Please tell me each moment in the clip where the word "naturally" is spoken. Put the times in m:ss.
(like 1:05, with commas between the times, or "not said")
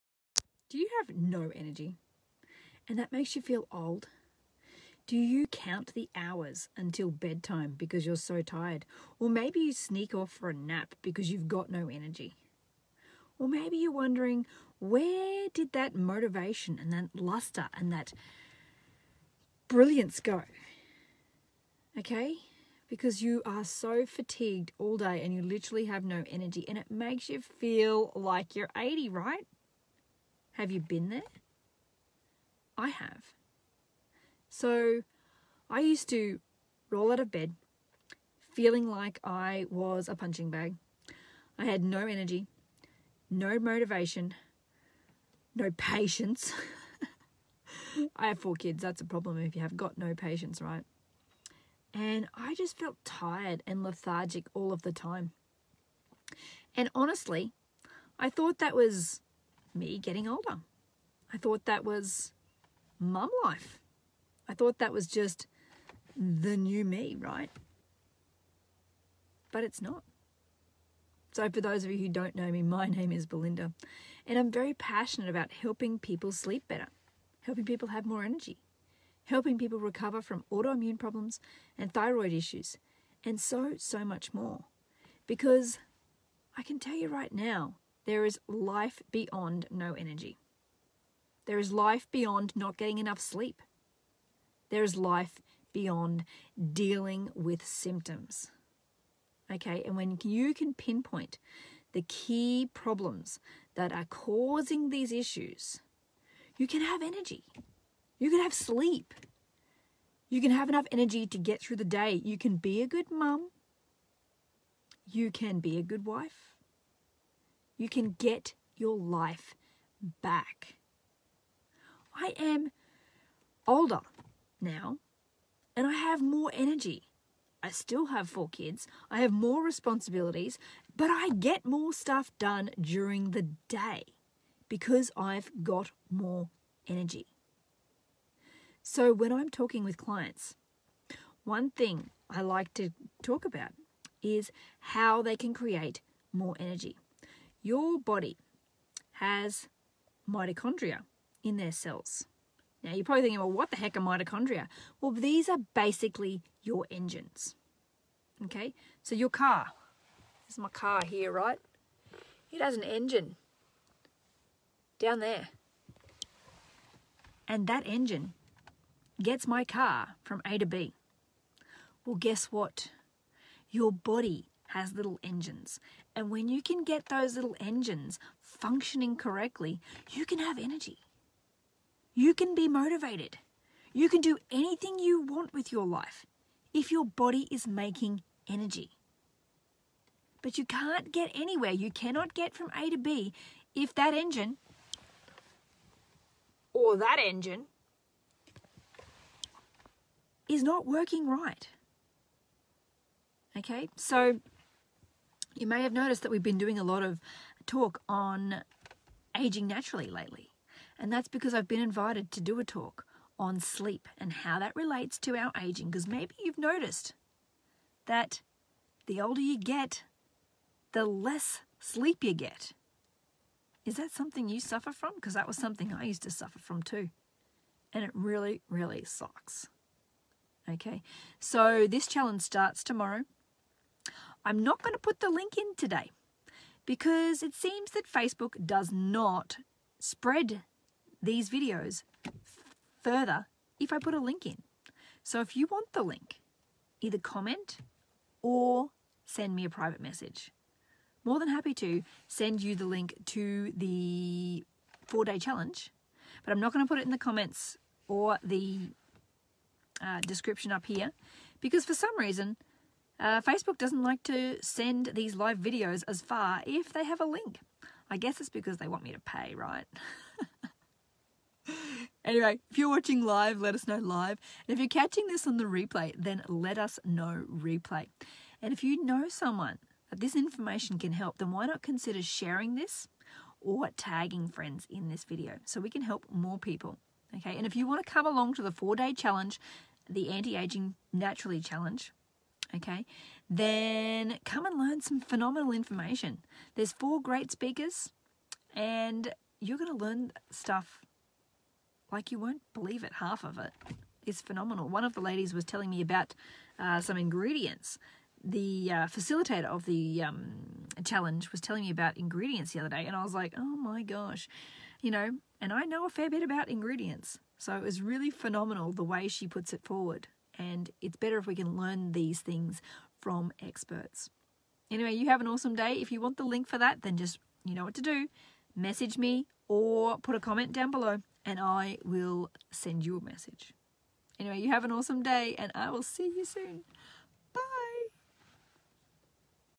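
3:29, 4:51.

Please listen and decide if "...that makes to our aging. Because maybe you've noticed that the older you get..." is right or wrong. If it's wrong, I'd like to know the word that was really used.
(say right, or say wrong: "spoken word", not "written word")
wrong: "relates", not "makes".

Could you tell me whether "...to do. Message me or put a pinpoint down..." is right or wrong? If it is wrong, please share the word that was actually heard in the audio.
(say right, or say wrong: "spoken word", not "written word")
wrong: "comment", not "pinpoint".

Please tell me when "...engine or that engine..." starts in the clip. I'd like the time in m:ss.
3:14.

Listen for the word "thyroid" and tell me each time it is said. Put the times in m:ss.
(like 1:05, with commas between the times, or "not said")
1:21.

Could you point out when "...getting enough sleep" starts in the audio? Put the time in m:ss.
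1:32.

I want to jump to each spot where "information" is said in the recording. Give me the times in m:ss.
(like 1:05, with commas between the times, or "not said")
4:40, 4:55.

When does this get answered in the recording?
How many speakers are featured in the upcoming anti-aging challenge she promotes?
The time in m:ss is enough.
4:56.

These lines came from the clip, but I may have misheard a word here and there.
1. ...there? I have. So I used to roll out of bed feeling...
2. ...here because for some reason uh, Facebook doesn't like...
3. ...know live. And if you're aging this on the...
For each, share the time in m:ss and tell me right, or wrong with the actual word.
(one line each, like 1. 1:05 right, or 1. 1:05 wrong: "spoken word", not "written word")
1. 0:31 right
2. 4:20 right
3. 4:33 wrong: "catching", not "aging".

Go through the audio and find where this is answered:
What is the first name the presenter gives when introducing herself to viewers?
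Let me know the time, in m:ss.
1:13.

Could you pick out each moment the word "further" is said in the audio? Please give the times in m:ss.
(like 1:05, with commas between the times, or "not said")
4:03.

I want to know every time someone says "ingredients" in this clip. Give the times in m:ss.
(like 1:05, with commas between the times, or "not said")
5:07, 5:12, 5:16.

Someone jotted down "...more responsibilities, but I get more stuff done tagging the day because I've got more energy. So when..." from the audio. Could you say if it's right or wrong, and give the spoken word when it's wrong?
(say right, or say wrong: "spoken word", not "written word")
wrong: "during", not "tagging".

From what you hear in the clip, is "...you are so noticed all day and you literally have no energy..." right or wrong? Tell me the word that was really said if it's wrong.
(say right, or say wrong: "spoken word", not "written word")
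wrong: "fatigued", not "noticed".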